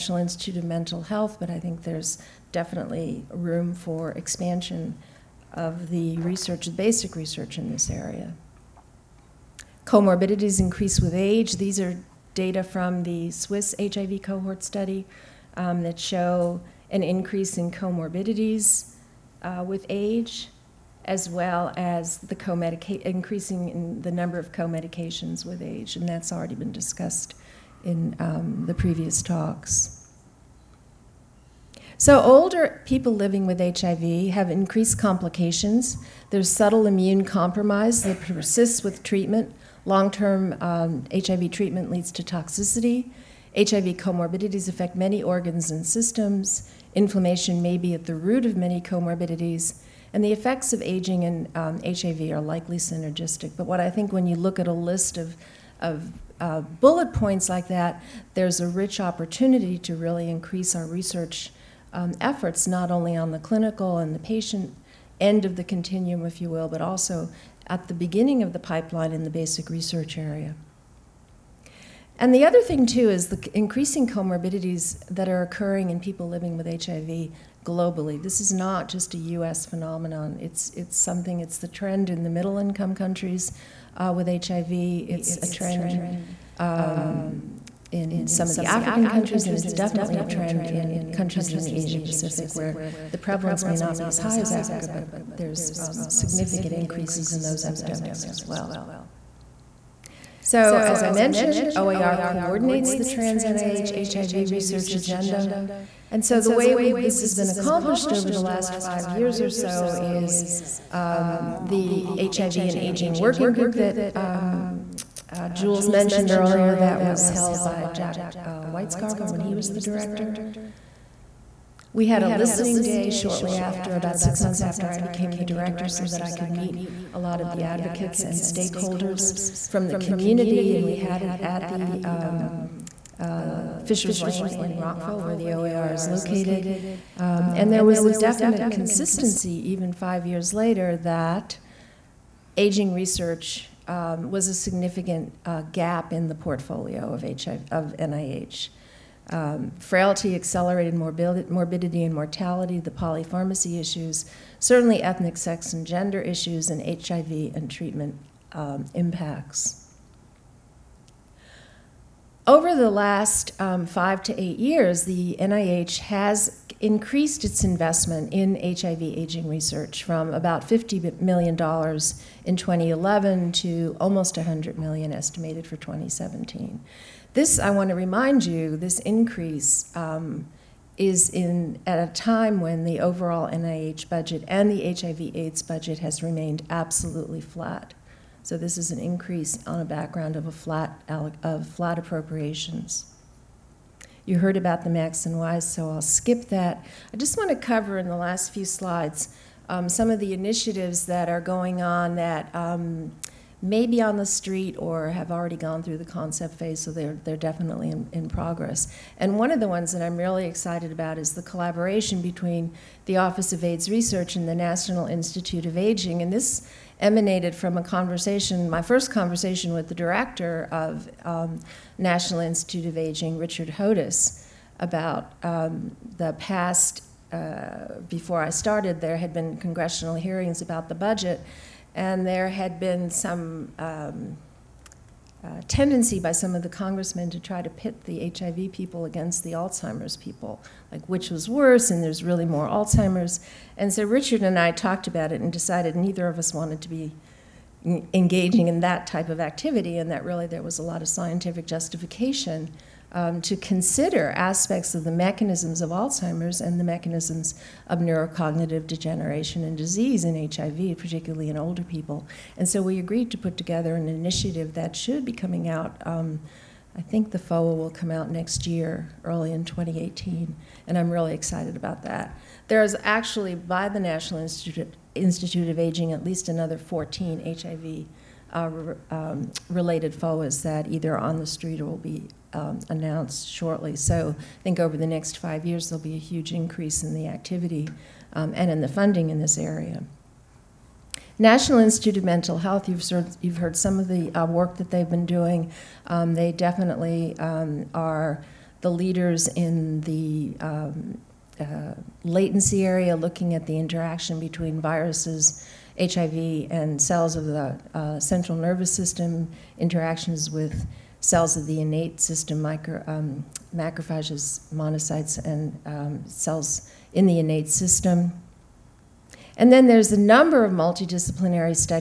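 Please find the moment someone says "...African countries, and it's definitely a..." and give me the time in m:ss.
1:28.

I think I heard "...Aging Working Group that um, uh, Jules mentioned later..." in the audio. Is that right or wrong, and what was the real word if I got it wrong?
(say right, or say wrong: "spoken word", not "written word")
wrong: "earlier", not "later".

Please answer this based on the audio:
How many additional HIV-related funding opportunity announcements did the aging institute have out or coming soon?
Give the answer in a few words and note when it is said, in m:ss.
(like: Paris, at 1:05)
14, at 4:36.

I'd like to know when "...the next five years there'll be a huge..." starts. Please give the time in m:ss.
4:44.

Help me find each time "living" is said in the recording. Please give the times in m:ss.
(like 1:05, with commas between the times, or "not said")
0:33, 1:16.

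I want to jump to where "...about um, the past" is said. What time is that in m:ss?
3:44.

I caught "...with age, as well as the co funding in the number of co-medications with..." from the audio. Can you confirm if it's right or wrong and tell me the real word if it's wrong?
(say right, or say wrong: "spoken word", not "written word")
wrong: "increasing", not "funding".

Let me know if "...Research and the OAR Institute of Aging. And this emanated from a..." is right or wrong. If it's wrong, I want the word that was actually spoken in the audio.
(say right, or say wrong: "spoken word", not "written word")
wrong: "National", not "OAR".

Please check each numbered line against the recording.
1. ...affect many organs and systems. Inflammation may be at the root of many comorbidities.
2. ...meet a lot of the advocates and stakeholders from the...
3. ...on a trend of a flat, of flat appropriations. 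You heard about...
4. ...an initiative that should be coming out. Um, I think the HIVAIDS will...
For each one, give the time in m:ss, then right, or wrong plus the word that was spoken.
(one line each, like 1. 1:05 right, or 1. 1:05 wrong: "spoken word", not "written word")
1. 0:44 right
2. 2:06 right
3. 3:09 wrong: "background", not "trend"
4. 4:23 wrong: "FOA", not "HIVAIDS".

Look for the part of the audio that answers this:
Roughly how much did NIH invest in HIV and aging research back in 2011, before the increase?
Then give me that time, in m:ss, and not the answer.
2:50.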